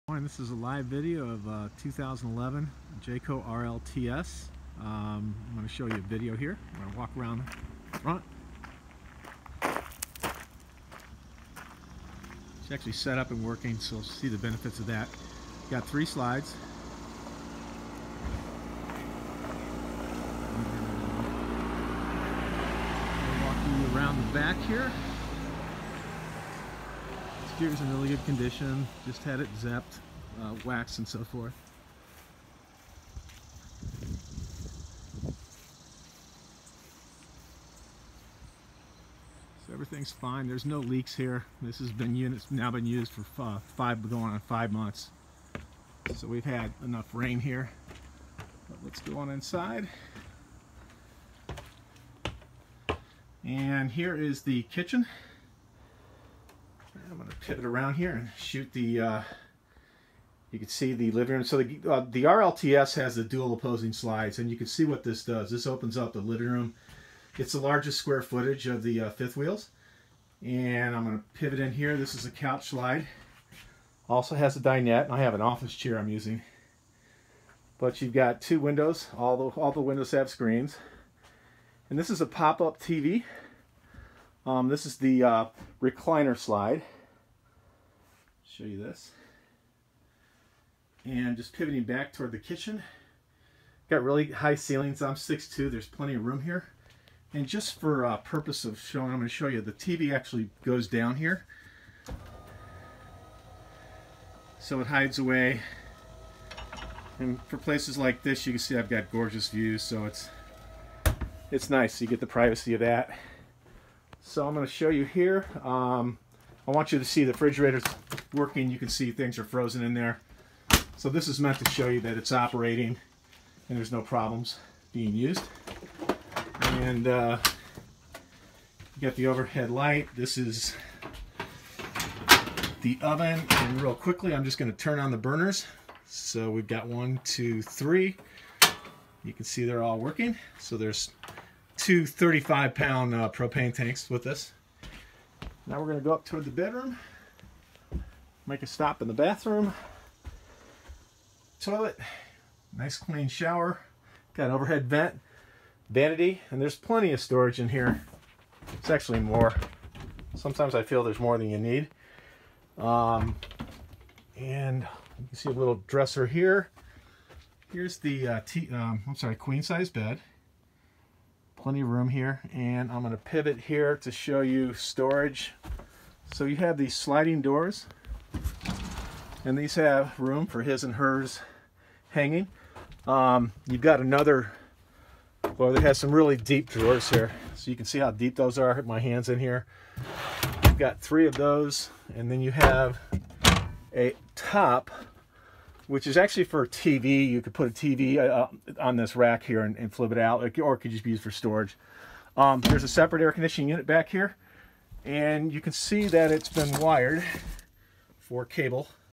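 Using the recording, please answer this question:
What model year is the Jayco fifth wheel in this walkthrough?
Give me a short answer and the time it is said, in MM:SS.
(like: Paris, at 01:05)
2011, at 00:01.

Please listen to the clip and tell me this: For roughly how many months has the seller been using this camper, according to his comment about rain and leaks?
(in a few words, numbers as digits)
5.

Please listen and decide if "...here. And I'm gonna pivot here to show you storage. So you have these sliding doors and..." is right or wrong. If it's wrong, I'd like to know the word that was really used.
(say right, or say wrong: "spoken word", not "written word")
right.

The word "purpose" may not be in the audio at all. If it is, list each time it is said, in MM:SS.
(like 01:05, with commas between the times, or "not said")
01:38.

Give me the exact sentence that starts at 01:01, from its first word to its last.
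So the, uh, the RLTS has the dual opposing slides, and you can see what this does.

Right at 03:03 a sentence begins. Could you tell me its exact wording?
Um, you've got another, well, it has some really deep drawers here.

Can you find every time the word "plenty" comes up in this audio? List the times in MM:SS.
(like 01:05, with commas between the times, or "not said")
01:35, 02:36, 02:51.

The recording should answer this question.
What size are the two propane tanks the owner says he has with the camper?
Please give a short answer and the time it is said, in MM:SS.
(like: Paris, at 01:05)
35 pound, at 02:22.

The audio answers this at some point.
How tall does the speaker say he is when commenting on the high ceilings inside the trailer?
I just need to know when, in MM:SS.
01:35.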